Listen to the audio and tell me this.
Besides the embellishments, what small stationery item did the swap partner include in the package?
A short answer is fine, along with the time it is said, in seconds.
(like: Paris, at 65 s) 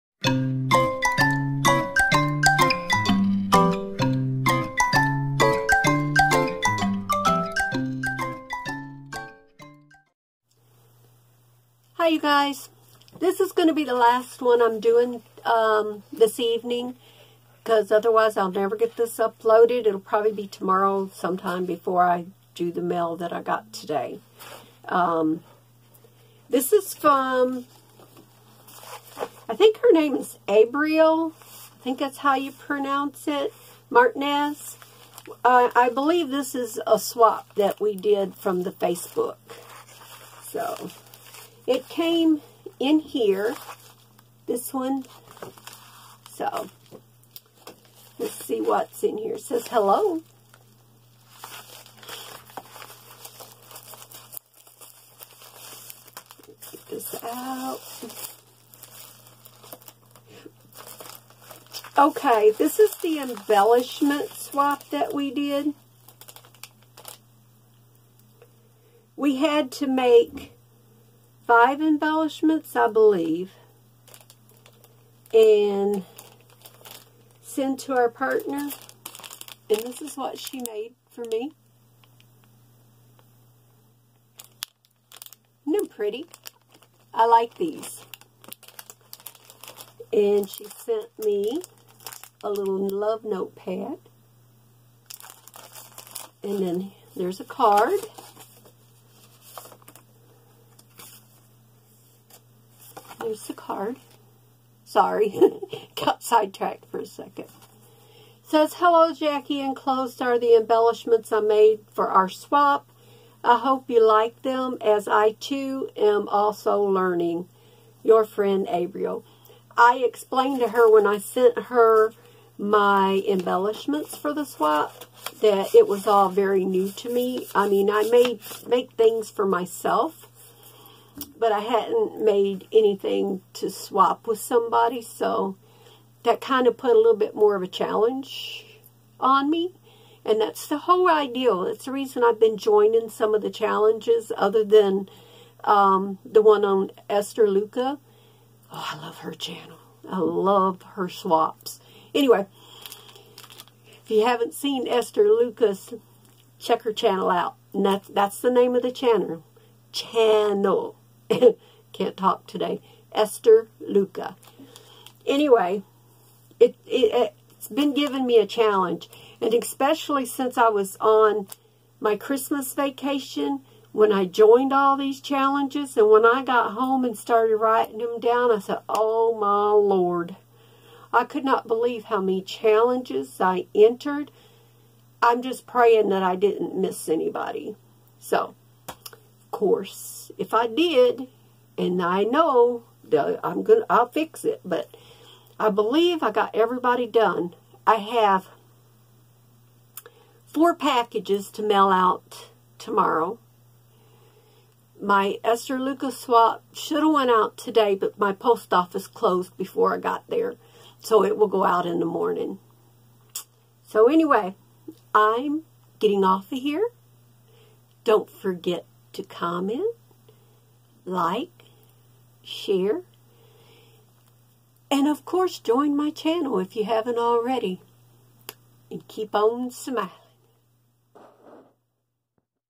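love notepad, at 92 s.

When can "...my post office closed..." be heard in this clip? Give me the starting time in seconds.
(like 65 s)
208 s.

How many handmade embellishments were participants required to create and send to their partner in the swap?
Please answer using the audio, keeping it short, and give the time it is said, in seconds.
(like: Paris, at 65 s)
5, at 71 s.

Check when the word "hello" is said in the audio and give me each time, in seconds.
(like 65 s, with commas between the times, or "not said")
49 s, 108 s.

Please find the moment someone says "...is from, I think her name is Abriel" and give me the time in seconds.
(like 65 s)
26 s.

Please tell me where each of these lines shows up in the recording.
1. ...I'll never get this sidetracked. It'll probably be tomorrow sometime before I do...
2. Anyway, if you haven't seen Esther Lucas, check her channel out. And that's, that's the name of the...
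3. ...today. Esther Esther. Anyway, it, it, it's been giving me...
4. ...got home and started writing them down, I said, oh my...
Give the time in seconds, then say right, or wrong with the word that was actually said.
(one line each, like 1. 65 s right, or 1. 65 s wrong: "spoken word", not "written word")
1. 18 s wrong: "uploaded", not "sidetracked"
2. 152 s right
3. 162 s wrong: "Luca", not "Esther"
4. 176 s right.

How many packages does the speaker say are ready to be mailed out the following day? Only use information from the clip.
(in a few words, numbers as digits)
4.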